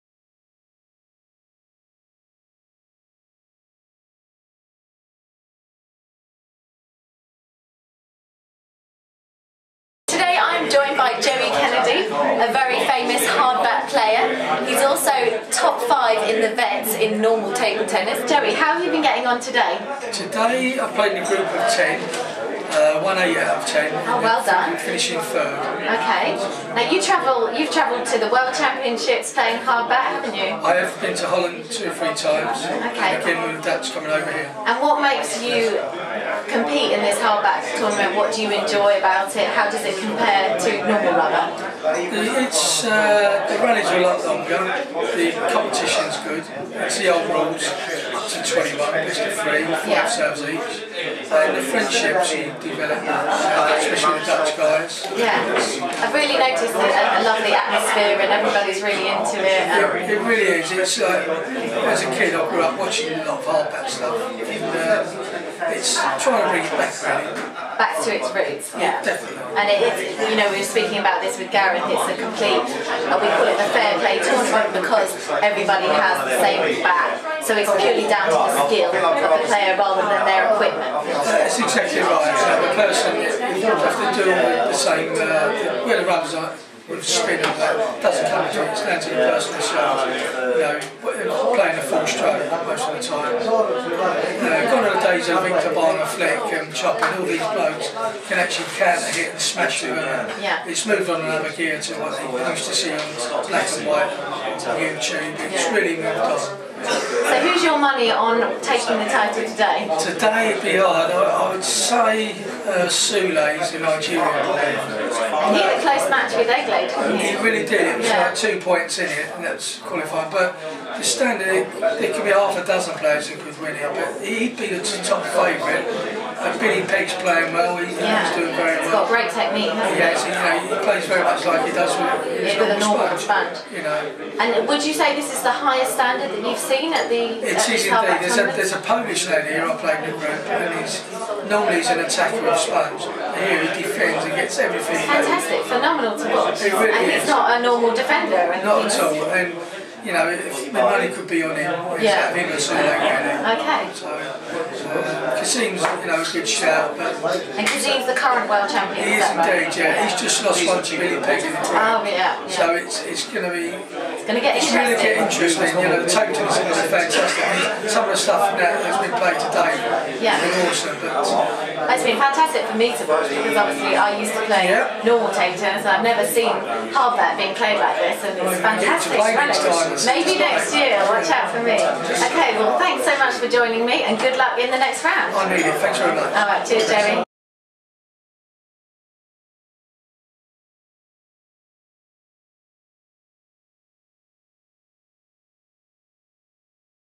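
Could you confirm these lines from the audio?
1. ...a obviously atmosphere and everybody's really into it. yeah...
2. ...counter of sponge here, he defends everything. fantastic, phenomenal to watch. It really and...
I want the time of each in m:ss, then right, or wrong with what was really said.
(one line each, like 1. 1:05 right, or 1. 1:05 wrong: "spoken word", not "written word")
1. 0:56 wrong: "lovely", not "obviously"
2. 2:21 wrong: "attacker", not "counter".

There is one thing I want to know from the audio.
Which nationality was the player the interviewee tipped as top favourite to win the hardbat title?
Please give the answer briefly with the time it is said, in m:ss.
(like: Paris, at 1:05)
Nigerian, at 1:53.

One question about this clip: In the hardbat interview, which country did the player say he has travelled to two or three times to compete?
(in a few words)
Holland.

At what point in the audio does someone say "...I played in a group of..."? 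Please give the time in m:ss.
0:20.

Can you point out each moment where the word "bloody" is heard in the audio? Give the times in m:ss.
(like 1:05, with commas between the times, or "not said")
not said.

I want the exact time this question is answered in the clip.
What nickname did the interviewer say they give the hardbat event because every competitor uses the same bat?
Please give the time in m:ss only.
1:13.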